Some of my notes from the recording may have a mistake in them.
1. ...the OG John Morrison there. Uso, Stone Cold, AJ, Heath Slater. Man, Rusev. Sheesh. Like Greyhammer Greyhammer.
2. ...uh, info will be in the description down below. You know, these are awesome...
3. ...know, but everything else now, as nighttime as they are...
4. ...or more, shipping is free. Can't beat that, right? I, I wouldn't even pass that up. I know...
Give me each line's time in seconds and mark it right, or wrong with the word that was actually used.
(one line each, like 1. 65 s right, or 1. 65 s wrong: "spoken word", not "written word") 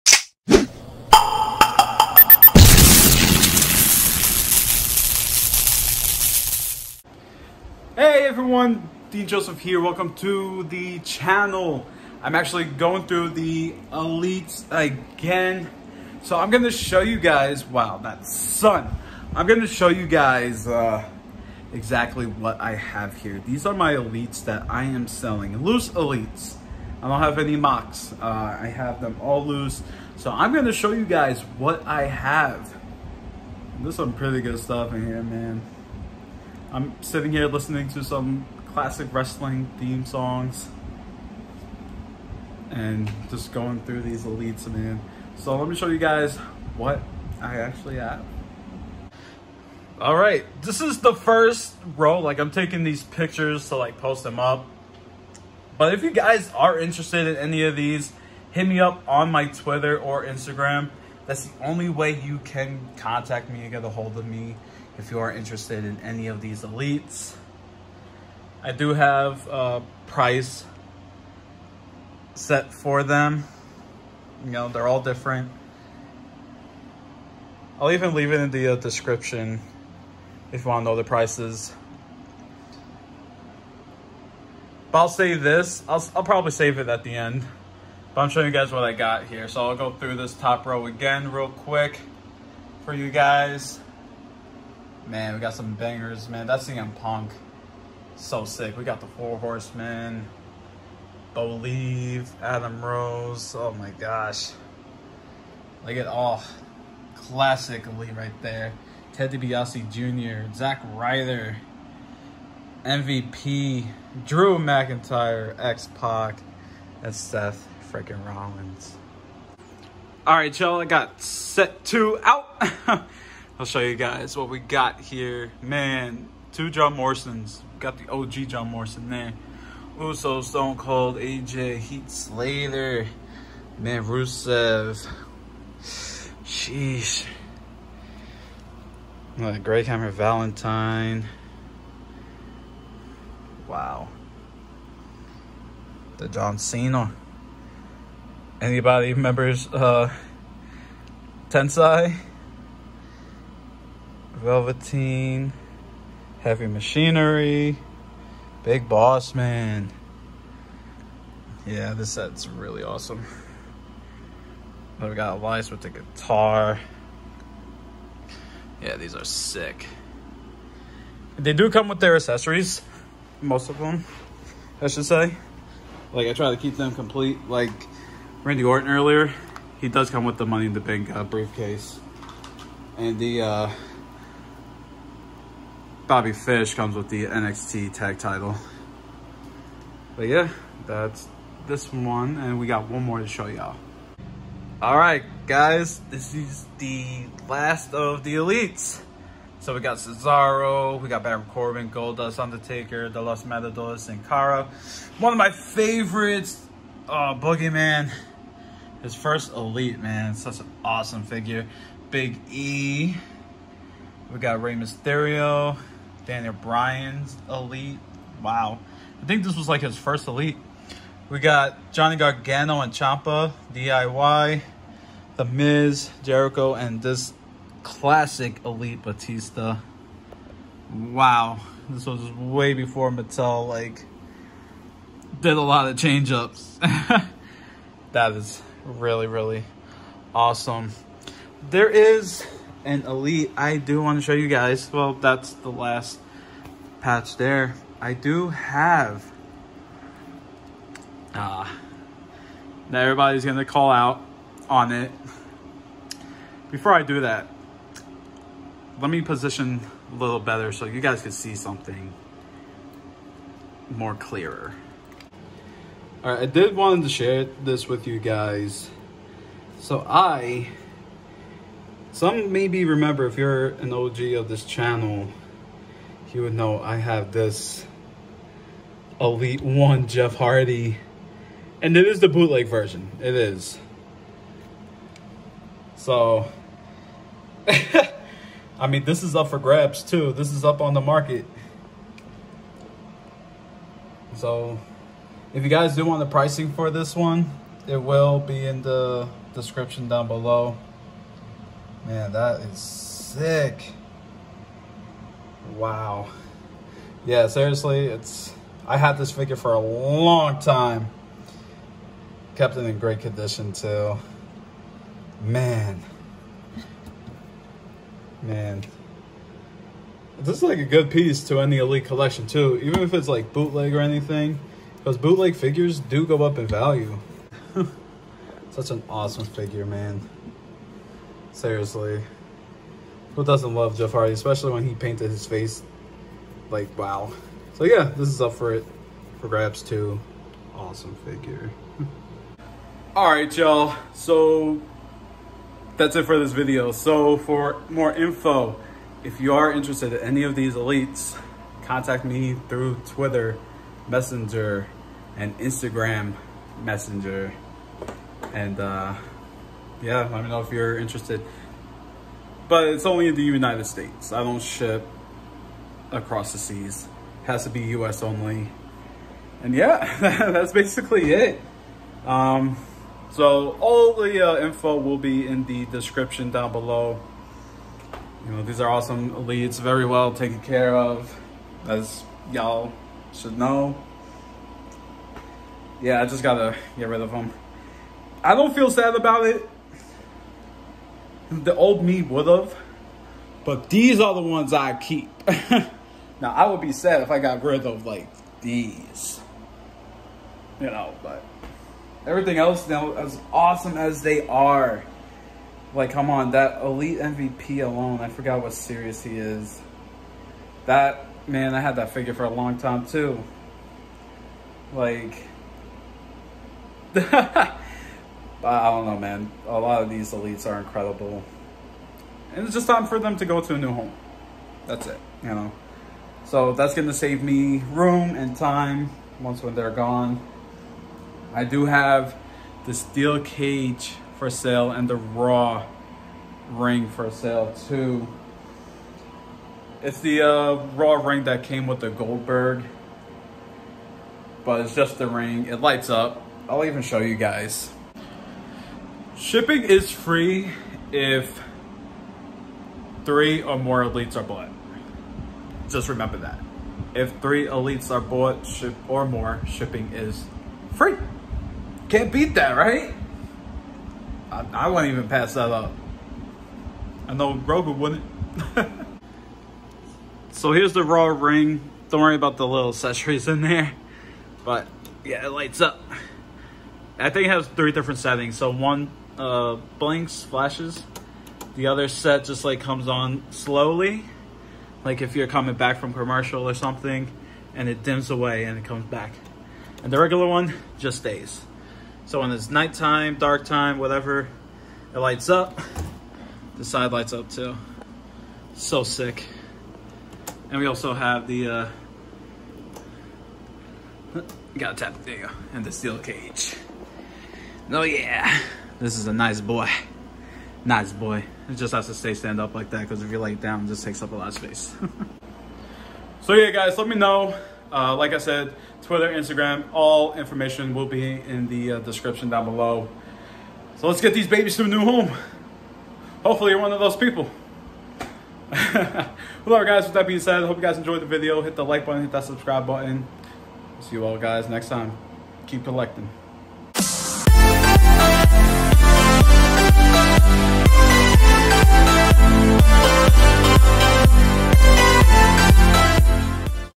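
1. 127 s wrong: "Valentine", not "Greyhammer"
2. 374 s right
3. 400 s wrong: "awesome", not "nighttime"
4. 459 s right.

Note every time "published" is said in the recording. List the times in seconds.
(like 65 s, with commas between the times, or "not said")
not said.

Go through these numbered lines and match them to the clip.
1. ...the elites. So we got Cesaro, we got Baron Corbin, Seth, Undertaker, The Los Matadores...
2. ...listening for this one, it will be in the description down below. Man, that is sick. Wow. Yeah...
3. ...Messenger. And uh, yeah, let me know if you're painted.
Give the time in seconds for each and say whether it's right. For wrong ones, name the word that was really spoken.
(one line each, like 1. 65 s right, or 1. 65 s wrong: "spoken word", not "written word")
1. 198 s wrong: "Goldust", not "Seth"
2. 296 s wrong: "pricing", not "listening"
3. 356 s wrong: "interested", not "painted".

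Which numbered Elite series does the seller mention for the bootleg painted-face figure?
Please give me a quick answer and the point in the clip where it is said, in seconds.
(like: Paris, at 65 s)
Elite 1, at 279 s.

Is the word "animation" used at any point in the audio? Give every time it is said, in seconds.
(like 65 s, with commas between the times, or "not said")
not said.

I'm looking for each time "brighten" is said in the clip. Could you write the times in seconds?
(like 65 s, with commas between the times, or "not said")
not said.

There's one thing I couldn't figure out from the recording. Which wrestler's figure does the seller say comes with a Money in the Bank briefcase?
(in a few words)
Randy Orton.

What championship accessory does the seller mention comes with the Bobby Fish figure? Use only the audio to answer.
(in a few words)
NXT tag title.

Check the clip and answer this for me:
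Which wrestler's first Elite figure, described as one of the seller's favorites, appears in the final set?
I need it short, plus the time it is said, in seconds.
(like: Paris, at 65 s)
Boogeyman, at 207 s.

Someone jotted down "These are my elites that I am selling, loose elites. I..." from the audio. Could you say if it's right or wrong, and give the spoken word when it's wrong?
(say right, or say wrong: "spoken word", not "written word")
right.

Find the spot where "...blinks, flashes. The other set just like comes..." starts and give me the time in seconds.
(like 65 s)
479 s.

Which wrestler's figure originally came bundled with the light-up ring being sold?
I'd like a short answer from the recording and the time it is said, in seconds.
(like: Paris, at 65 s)
Goldberg, at 442 s.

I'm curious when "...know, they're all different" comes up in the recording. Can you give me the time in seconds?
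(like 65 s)
74 s.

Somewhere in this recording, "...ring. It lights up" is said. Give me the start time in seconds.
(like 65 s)
445 s.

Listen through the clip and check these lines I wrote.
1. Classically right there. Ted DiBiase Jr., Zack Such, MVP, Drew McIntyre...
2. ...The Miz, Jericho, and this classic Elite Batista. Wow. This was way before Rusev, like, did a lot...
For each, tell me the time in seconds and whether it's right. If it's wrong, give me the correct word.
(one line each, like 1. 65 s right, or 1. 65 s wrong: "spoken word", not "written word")
1. 107 s wrong: "Ryder", not "Such"
2. 225 s wrong: "Mattel", not "Rusev".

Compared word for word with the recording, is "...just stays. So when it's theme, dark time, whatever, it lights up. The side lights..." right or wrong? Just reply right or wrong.
wrong.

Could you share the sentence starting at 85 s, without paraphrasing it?
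I'll, I'll probably save it at the end.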